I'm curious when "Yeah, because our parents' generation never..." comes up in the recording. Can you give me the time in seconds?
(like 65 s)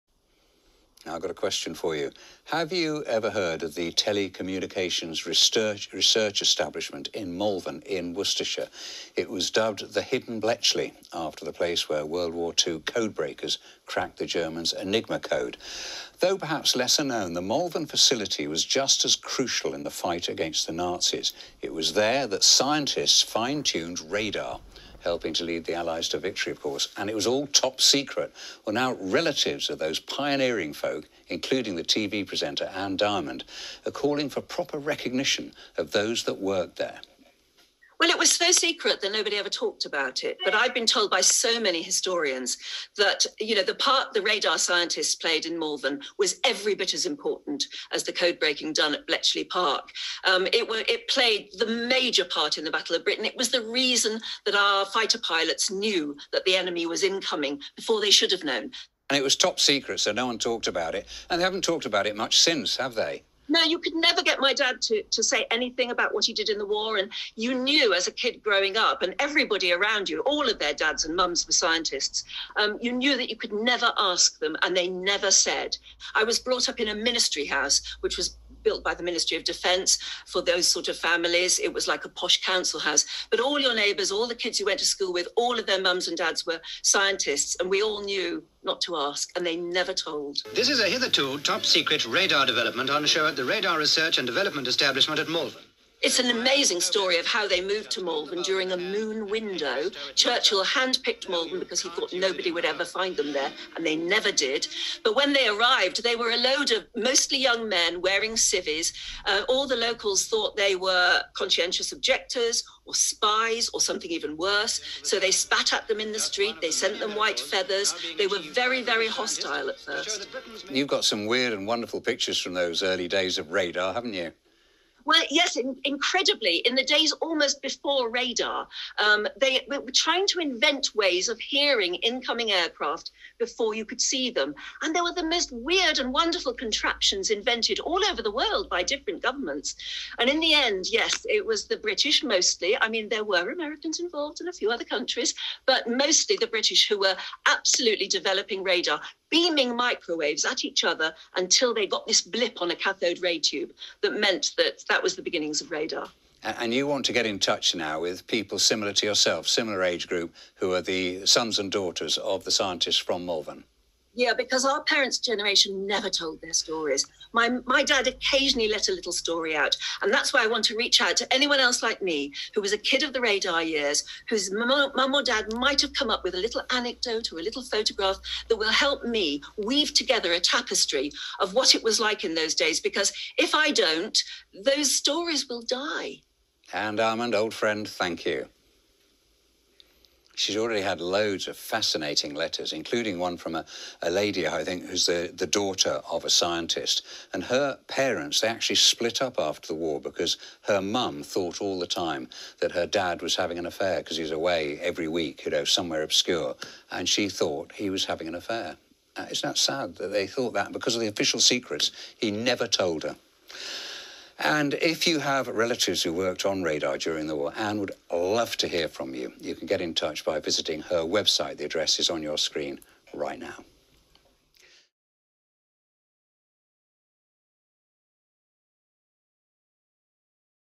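164 s.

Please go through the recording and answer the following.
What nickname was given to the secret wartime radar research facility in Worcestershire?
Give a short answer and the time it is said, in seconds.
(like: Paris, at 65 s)
Hidden Bletchley, at 10 s.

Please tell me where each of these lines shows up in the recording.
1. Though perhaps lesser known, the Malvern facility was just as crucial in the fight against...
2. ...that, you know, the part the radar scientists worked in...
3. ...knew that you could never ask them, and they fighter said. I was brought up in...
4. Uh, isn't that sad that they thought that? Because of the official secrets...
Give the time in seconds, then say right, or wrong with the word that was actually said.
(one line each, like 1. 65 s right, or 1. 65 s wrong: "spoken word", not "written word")
1. 16 s right
2. 42 s wrong: "played", not "worked"
3. 72 s wrong: "never", not "fighter"
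4. 209 s right.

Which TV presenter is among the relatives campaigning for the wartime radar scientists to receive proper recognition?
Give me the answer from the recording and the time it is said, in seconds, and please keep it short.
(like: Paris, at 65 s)
Anne Diamond, at 32 s.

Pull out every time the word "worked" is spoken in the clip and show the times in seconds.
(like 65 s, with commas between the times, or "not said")
36 s, 216 s.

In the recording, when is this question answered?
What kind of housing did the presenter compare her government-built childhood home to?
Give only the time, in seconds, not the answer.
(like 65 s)
82 s.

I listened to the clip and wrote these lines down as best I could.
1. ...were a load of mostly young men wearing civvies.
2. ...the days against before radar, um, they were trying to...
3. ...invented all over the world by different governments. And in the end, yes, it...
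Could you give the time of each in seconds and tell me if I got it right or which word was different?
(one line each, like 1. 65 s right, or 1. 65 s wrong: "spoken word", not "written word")
1. 106 s right
2. 126 s wrong: "almost", not "against"
3. 137 s right.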